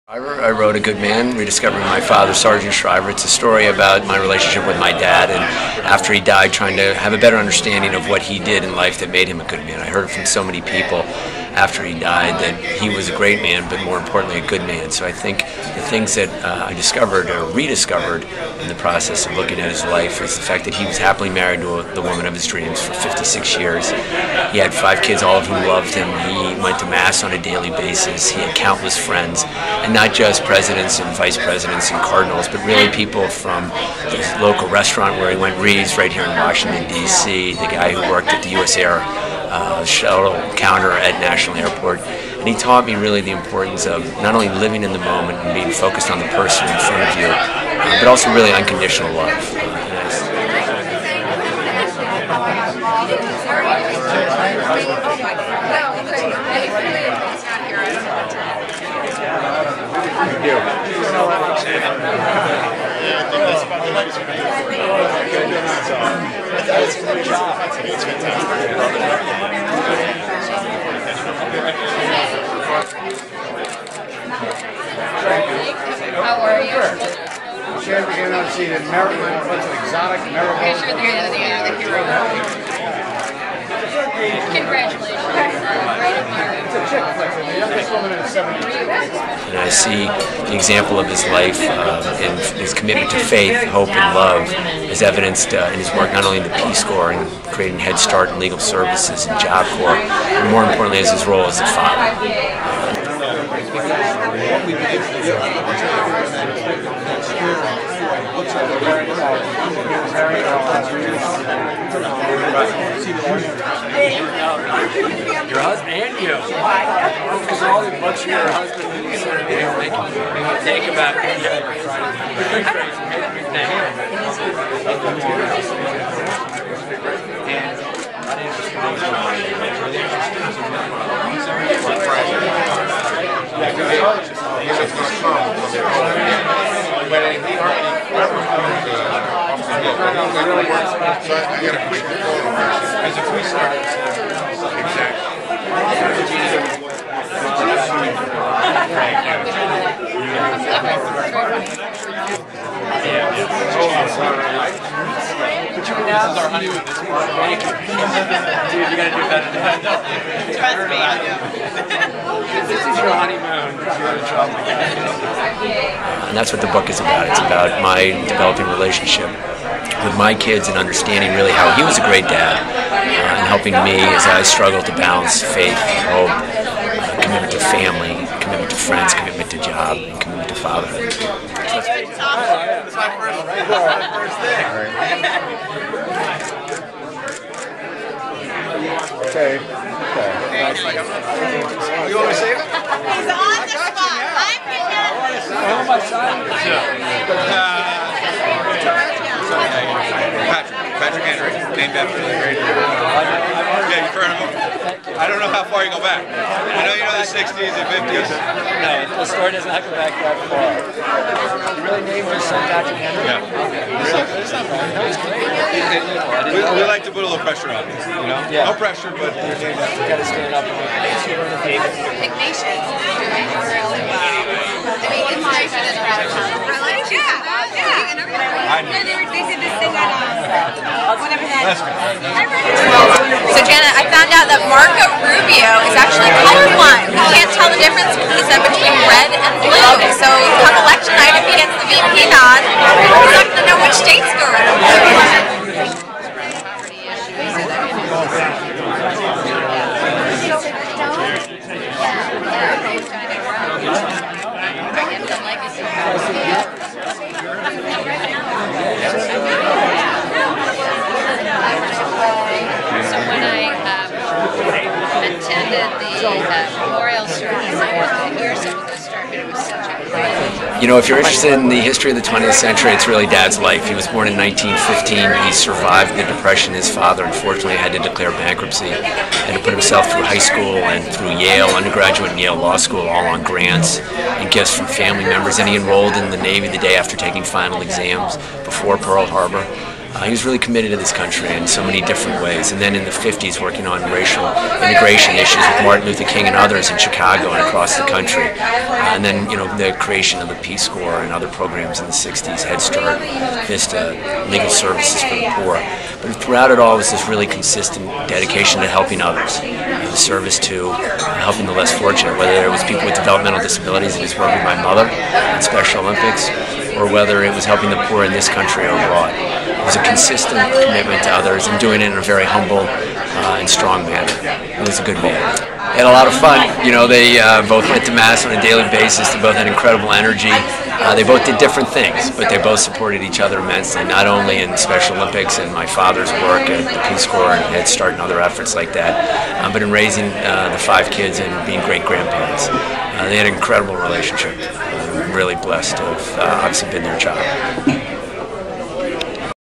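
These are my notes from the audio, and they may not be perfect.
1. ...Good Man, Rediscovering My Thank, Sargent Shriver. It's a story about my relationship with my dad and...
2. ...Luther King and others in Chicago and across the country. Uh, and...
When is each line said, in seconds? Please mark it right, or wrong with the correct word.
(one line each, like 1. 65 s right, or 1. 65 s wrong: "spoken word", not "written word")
1. 0 s wrong: "Father", not "Thank"
2. 296 s right.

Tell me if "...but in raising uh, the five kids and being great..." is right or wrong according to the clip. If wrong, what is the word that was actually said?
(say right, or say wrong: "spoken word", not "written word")
right.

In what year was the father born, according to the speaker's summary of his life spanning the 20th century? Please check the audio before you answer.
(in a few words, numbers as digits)
1915.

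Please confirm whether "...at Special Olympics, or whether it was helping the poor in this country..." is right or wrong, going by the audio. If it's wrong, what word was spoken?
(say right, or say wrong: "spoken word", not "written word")
right.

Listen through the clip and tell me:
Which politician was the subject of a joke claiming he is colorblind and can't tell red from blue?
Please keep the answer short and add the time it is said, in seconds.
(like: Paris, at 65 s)
Marco Rubio, at 234 s.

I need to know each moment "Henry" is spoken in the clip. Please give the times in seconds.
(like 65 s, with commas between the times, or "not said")
201 s, 212 s.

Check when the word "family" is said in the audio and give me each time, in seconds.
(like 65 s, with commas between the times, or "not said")
177 s, 284 s.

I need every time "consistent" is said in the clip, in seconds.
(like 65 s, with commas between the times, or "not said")
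307 s, 320 s.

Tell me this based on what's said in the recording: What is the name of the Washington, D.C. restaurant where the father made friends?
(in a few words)
Reeves.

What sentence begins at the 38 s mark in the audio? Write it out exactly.
Air uh, shuttle counter at National Airport.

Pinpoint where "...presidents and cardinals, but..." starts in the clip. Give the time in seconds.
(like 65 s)
31 s.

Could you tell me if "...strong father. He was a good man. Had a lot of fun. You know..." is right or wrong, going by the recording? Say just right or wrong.
wrong.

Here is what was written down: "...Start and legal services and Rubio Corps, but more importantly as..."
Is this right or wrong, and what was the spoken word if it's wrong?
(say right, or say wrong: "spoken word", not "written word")
wrong: "Job", not "Rubio".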